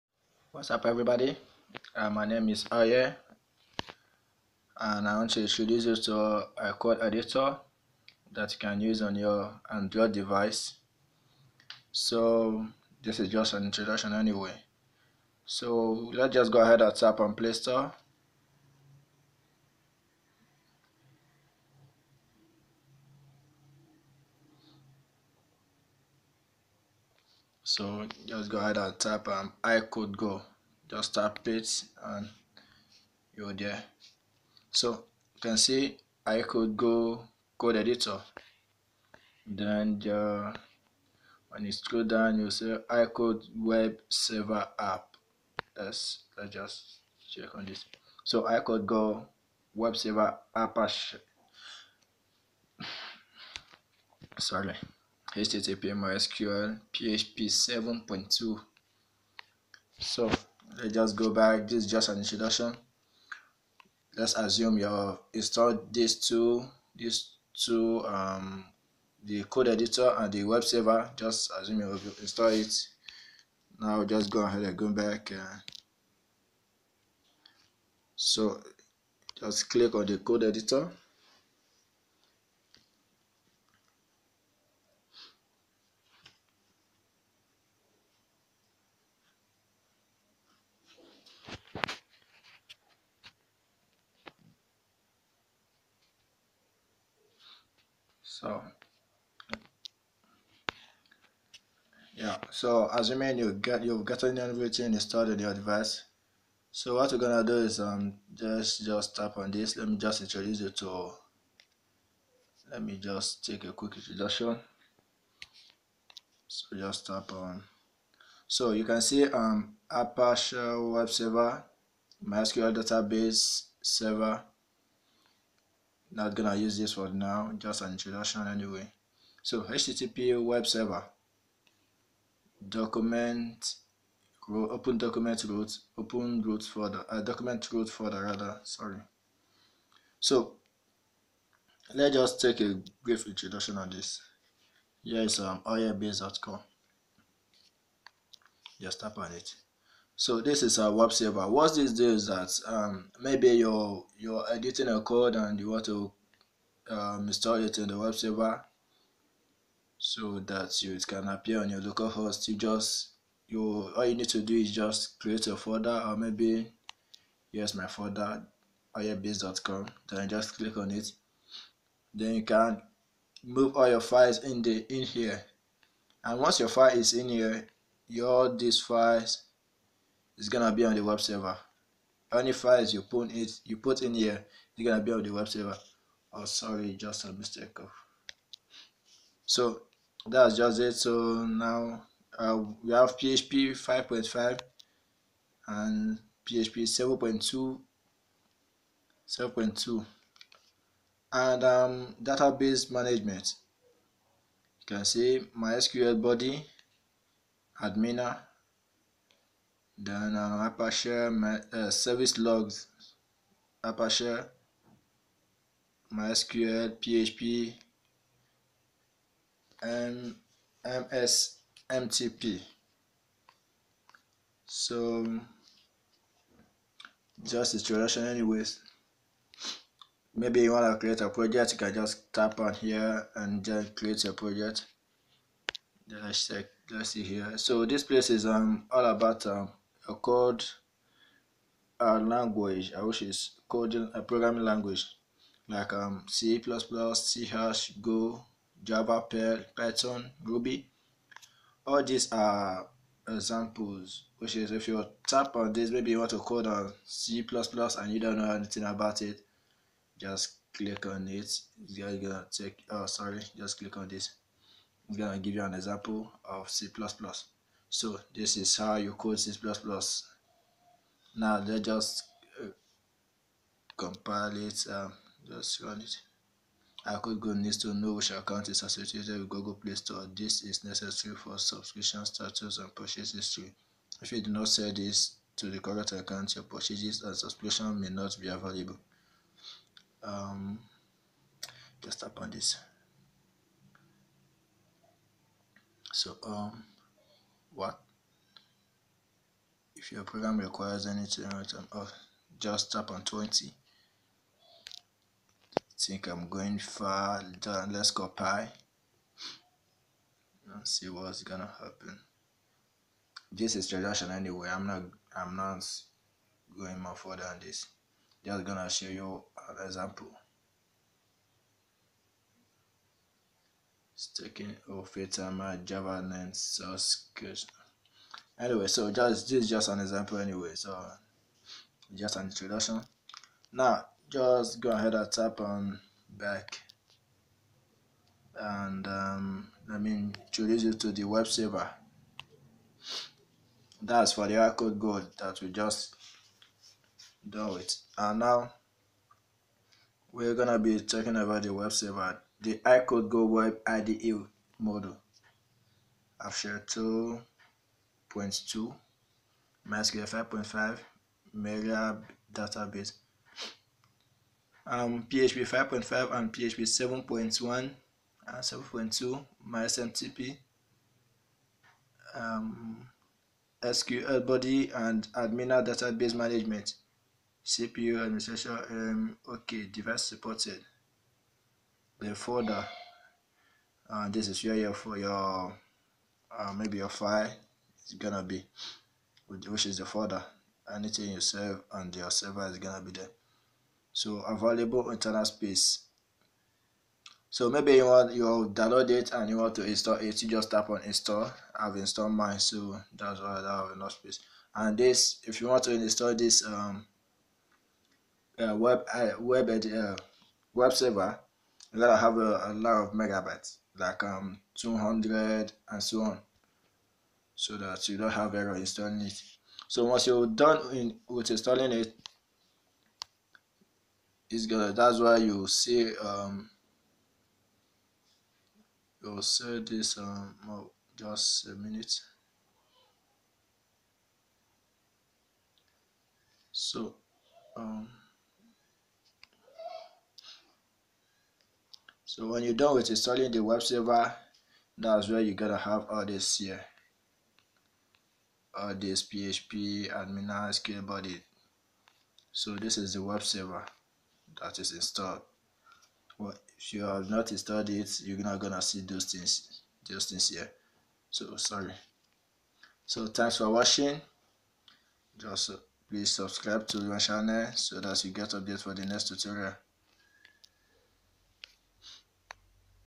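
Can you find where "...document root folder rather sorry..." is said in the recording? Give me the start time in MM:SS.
02:17.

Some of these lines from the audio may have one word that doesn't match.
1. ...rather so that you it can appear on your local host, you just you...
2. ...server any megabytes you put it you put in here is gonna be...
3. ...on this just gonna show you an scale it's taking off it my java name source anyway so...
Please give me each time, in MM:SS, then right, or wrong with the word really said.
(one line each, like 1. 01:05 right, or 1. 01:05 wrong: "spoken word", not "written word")
1. 02:38 wrong: "server", not "rather"
2. 03:01 wrong: "files", not "megabytes"
3. 05:17 wrong: "example", not "scale".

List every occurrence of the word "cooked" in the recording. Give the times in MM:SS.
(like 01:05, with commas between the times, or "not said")
not said.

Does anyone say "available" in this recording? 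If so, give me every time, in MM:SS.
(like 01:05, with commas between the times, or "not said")
04:48, 06:34.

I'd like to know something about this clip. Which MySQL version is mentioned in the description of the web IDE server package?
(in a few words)
5.5.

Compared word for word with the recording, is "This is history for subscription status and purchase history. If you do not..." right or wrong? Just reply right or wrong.
wrong.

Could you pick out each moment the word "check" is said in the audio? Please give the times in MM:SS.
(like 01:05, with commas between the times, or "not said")
00:47, 03:56.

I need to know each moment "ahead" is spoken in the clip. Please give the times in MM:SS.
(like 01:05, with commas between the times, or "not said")
00:16, 00:28, 01:14, 05:34.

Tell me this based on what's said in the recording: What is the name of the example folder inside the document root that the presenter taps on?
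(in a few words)
oilbase.com.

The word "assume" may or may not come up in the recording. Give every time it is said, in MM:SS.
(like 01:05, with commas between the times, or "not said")
01:04, 01:11.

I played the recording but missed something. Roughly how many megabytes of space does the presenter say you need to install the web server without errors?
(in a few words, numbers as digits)
200.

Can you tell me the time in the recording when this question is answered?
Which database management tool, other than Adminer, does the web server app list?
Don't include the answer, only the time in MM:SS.
03:25.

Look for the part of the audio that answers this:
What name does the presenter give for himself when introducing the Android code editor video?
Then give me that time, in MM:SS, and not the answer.
00:02.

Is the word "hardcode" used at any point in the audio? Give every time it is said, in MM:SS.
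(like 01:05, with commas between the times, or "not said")
05:44, 05:52.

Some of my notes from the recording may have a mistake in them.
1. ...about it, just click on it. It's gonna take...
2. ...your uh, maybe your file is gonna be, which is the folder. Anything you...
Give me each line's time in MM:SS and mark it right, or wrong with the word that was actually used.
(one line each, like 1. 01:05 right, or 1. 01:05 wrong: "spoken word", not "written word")
1. 04:18 right
2. 06:25 right.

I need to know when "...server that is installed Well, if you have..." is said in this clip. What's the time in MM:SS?
07:33.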